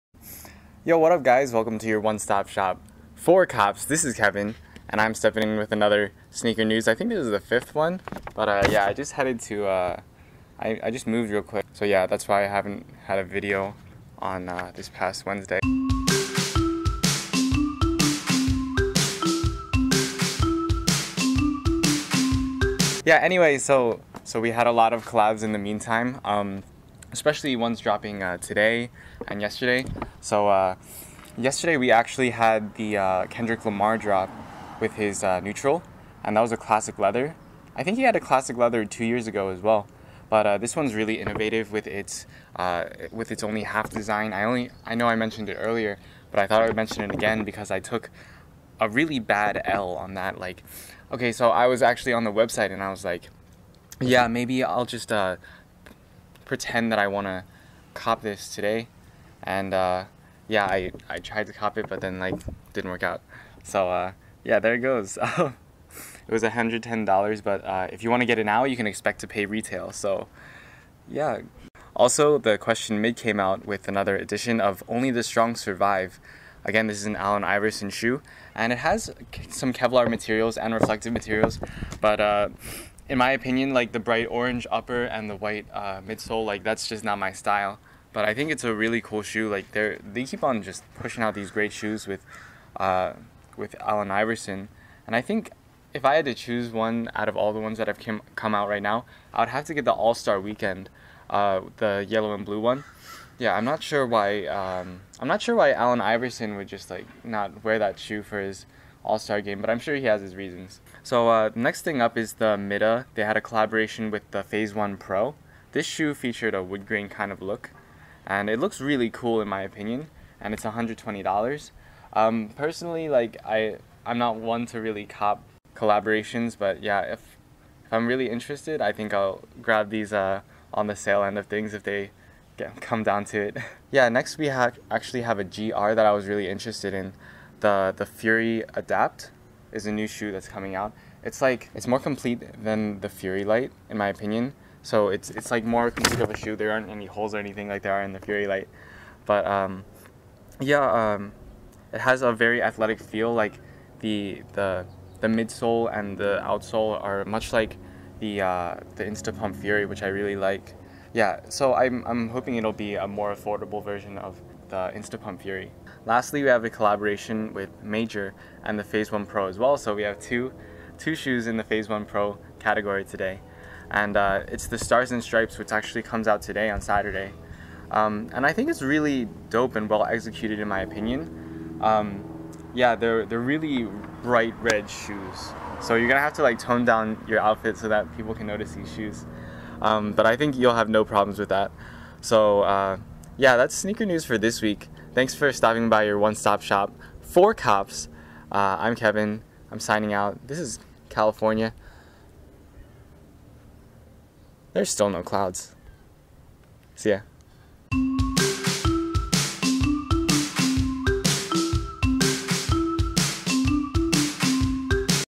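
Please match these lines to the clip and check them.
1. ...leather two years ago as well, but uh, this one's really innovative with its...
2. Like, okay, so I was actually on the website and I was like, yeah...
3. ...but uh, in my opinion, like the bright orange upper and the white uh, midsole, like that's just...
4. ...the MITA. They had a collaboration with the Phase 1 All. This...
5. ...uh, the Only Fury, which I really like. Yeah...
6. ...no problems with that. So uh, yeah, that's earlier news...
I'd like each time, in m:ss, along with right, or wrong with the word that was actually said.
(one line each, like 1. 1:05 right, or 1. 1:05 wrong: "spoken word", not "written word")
1. 0:38 right
2. 0:50 right
3. 1:22 right
4. 1:52 wrong: "Pro", not "All"
5. 2:38 wrong: "Instapump", not "Only"
6. 3:10 wrong: "sneaker", not "earlier".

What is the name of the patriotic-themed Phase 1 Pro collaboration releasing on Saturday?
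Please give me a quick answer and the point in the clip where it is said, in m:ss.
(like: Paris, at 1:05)
Stars and Stripes, at 2:54.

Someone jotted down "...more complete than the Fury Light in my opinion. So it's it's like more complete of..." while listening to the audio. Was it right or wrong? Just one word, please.
right.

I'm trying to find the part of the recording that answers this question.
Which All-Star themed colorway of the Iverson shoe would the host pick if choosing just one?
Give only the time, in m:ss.
1:41.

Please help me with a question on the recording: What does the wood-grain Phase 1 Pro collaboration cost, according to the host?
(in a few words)
$120.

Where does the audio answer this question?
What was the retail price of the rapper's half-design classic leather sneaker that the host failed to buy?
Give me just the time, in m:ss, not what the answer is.
1:06.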